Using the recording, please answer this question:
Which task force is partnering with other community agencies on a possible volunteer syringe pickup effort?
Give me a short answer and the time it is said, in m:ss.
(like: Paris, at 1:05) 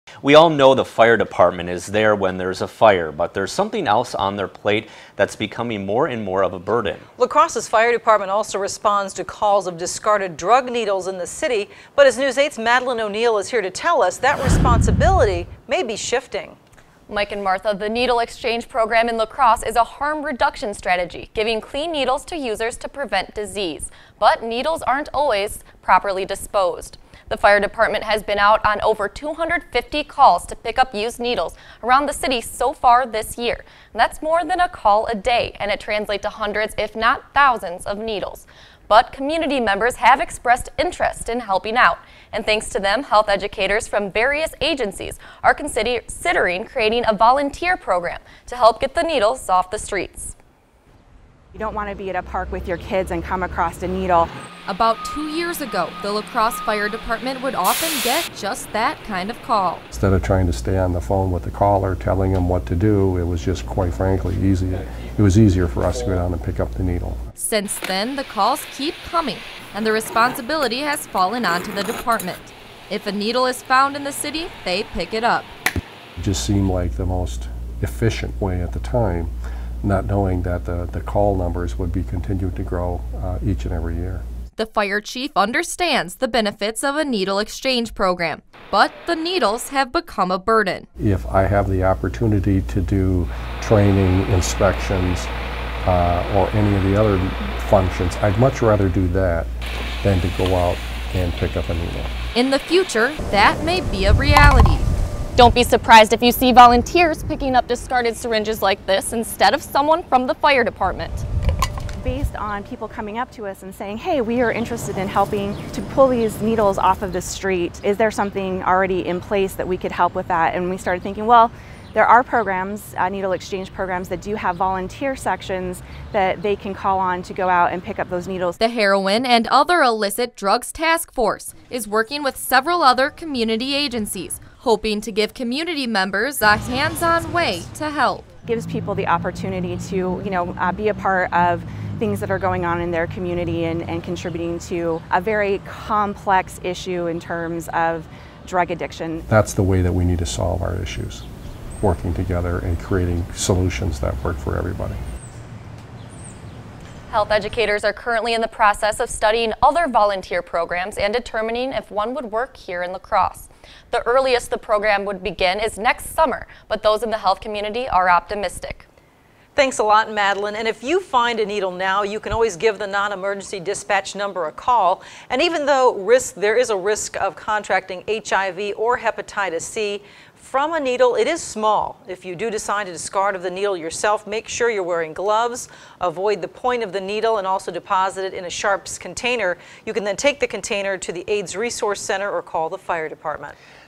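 Heroin and Other Illicit Drugs Task Force, at 2:08.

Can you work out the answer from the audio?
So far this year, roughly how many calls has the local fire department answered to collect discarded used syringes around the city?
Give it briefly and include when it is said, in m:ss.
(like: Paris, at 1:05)
over 250, at 0:28.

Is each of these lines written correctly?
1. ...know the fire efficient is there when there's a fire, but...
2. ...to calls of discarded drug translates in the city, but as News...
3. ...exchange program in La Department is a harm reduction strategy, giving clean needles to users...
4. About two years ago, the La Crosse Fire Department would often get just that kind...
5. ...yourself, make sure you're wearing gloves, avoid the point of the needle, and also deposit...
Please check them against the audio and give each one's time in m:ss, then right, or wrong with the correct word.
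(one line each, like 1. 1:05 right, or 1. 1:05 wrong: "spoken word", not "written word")
1. 0:00 wrong: "department", not "efficient"
2. 0:09 wrong: "needles", not "translates"
3. 0:18 wrong: "Crosse", not "Department"
4. 0:54 right
5. 3:03 right.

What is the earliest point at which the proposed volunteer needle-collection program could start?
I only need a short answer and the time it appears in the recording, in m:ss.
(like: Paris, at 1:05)
next summer, at 2:45.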